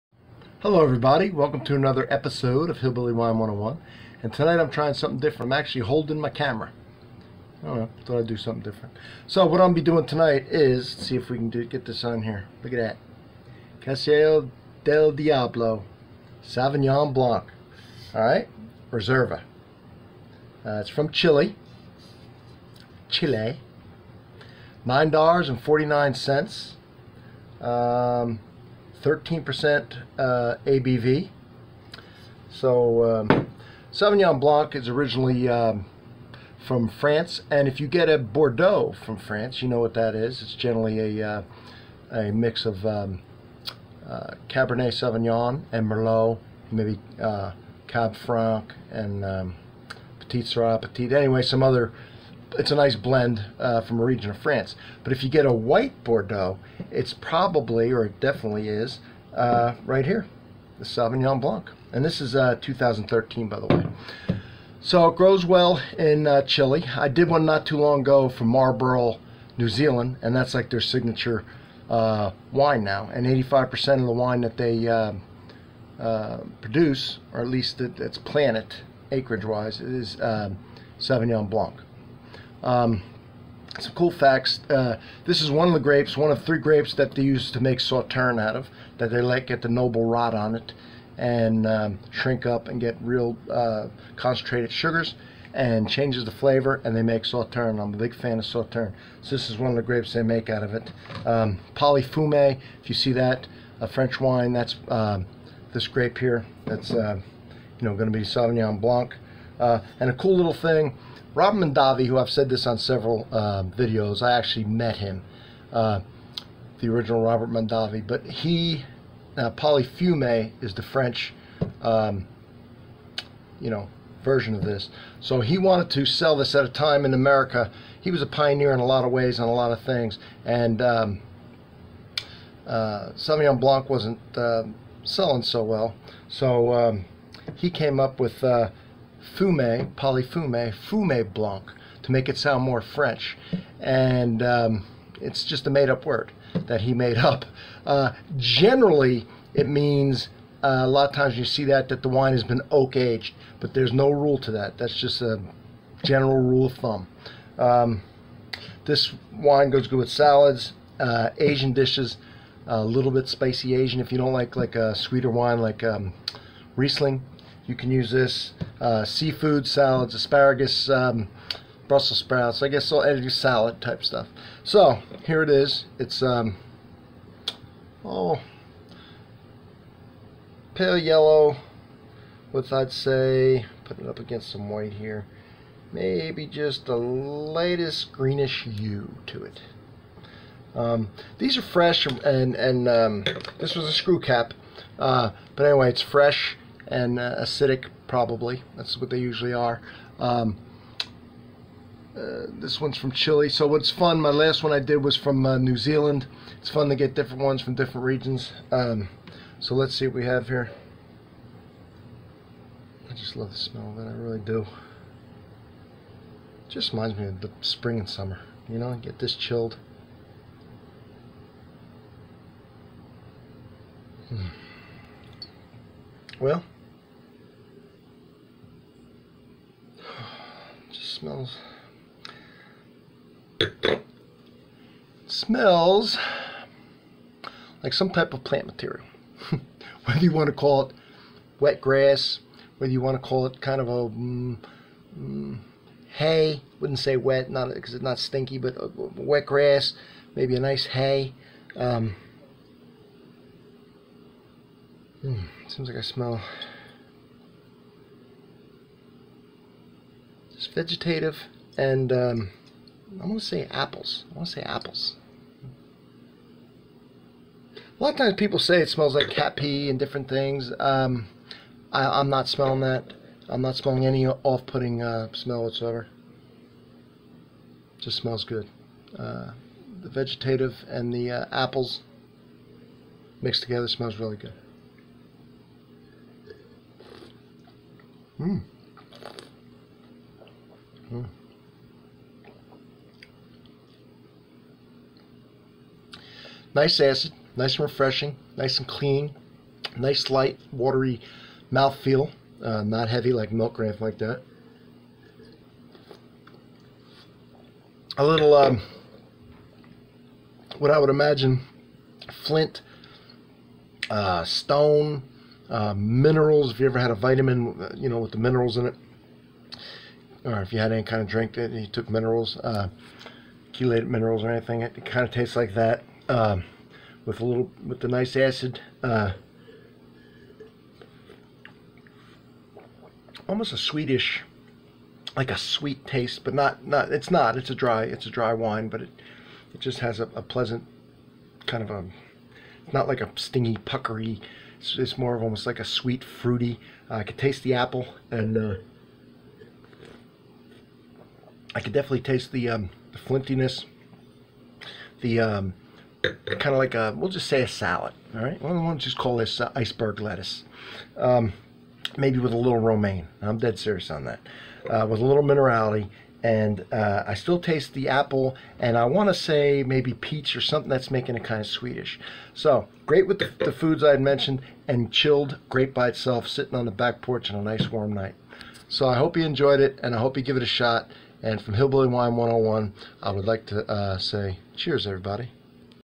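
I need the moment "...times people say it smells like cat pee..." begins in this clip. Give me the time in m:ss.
4:28.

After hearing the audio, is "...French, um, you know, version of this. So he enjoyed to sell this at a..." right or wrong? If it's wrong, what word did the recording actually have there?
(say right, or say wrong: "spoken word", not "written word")
wrong: "wanted", not "enjoyed".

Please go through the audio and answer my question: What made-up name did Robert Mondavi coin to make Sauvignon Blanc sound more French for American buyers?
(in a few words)
fume blanc.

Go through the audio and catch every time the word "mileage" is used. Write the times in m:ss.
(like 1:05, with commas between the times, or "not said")
not said.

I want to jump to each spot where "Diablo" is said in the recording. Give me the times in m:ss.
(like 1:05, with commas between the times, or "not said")
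0:15.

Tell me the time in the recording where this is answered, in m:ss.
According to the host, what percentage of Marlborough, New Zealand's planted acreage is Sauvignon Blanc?
1:13.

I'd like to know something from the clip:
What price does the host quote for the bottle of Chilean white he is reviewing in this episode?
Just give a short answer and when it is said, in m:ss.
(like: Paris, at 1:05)
$9.49, at 0:24.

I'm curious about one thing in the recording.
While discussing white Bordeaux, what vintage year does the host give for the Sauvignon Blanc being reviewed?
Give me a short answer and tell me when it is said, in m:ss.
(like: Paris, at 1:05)
2013, at 1:02.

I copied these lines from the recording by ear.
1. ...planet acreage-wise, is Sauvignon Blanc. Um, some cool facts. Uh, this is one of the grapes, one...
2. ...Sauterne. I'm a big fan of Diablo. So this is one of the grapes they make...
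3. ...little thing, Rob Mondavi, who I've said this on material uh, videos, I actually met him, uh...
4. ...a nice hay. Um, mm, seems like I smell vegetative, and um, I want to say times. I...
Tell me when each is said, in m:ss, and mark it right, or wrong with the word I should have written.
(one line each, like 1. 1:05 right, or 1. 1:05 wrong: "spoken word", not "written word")
1. 1:18 right
2. 1:37 wrong: "Sauterne", not "Diablo"
3. 1:50 wrong: "several", not "material"
4. 4:10 wrong: "apples", not "times".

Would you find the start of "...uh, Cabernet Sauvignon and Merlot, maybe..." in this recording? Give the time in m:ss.
0:44.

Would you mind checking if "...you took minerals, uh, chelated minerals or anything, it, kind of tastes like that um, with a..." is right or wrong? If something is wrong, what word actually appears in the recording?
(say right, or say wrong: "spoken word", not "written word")
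right.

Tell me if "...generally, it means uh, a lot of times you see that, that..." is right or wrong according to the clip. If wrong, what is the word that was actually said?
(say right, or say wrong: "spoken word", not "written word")
right.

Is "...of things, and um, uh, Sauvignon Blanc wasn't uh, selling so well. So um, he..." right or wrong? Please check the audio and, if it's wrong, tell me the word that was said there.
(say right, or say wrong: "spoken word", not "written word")
right.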